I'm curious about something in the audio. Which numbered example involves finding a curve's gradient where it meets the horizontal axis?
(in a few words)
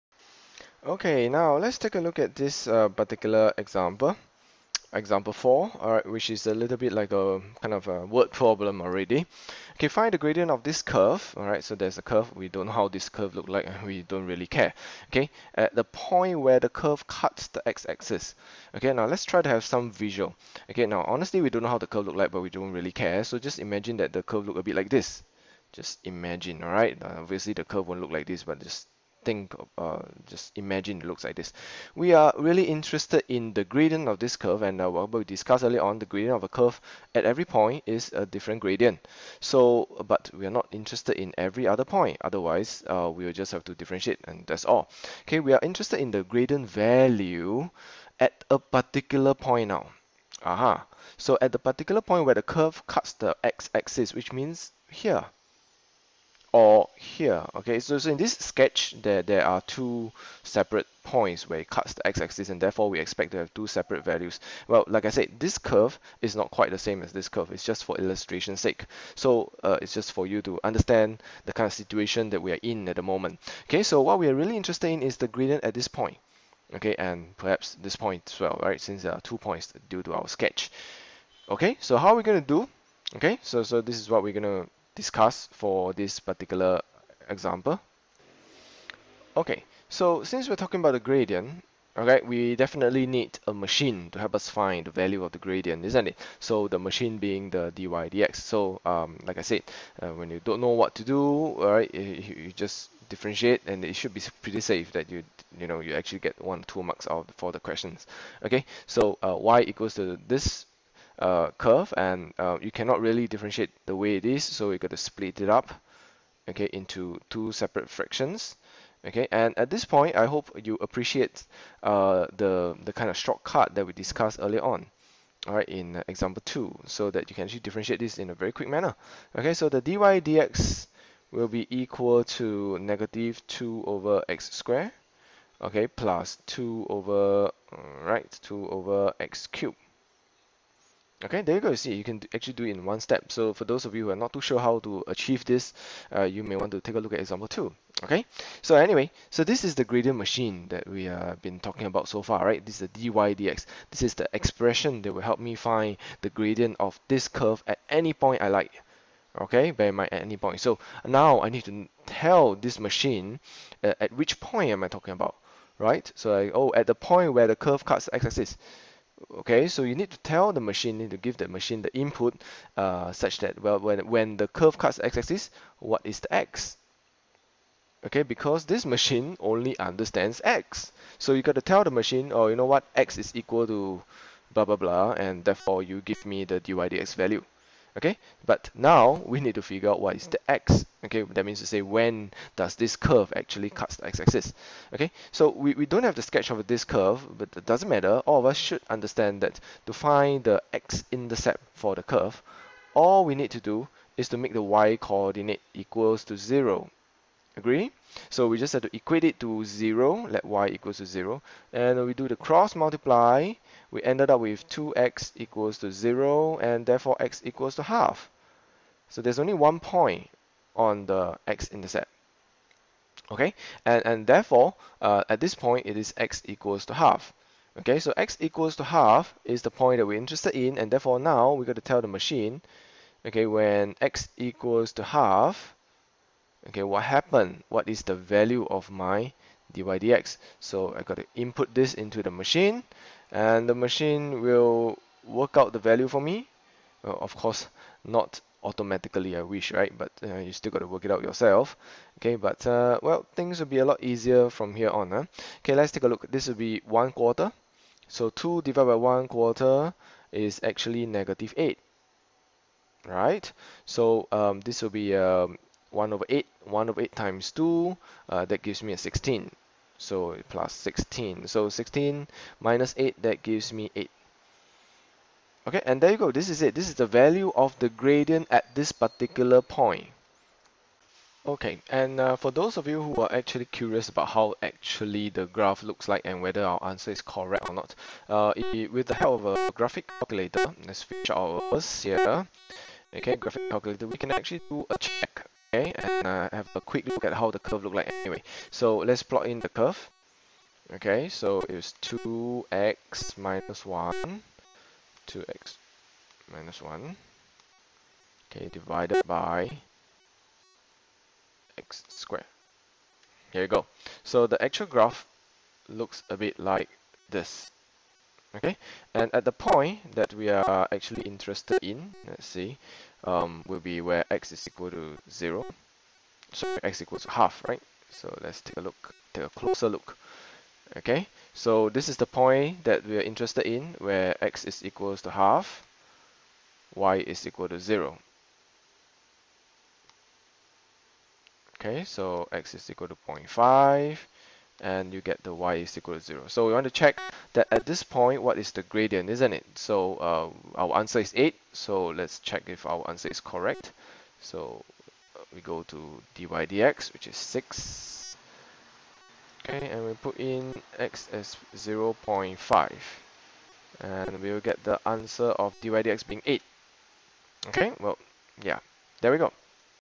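Example 4.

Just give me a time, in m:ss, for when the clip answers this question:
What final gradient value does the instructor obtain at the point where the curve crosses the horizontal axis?
4:33.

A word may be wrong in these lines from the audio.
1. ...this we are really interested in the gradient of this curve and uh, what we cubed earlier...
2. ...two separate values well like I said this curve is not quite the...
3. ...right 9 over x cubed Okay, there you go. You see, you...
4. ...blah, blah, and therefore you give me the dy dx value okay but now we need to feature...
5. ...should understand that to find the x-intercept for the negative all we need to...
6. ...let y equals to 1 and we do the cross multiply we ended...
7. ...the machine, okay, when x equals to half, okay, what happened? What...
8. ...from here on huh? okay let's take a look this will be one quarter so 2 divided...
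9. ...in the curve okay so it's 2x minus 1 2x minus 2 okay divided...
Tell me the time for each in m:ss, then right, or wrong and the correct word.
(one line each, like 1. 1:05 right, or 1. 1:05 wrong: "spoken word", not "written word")
1. 0:31 wrong: "discussed", not "cubed"
2. 1:03 right
3. 2:18 wrong: "2", not "9"
4. 3:04 wrong: "figure", not "feature"
5. 3:18 wrong: "curve", not "negative"
6. 3:30 wrong: "0", not "1"
7. 3:52 right
8. 4:14 right
9. 4:59 wrong: "1", not "2".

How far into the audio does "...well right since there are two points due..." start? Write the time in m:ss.
1:18.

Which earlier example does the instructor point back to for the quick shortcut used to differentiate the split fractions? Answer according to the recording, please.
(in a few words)
Example 2.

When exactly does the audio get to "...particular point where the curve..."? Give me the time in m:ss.
0:51.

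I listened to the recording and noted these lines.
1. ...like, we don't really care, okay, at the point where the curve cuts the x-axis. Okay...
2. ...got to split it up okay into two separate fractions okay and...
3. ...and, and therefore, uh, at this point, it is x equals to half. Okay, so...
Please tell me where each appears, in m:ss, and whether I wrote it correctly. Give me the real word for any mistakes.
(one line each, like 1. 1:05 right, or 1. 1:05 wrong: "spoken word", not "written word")
1. 0:13 right
2. 1:54 right
3. 3:43 right.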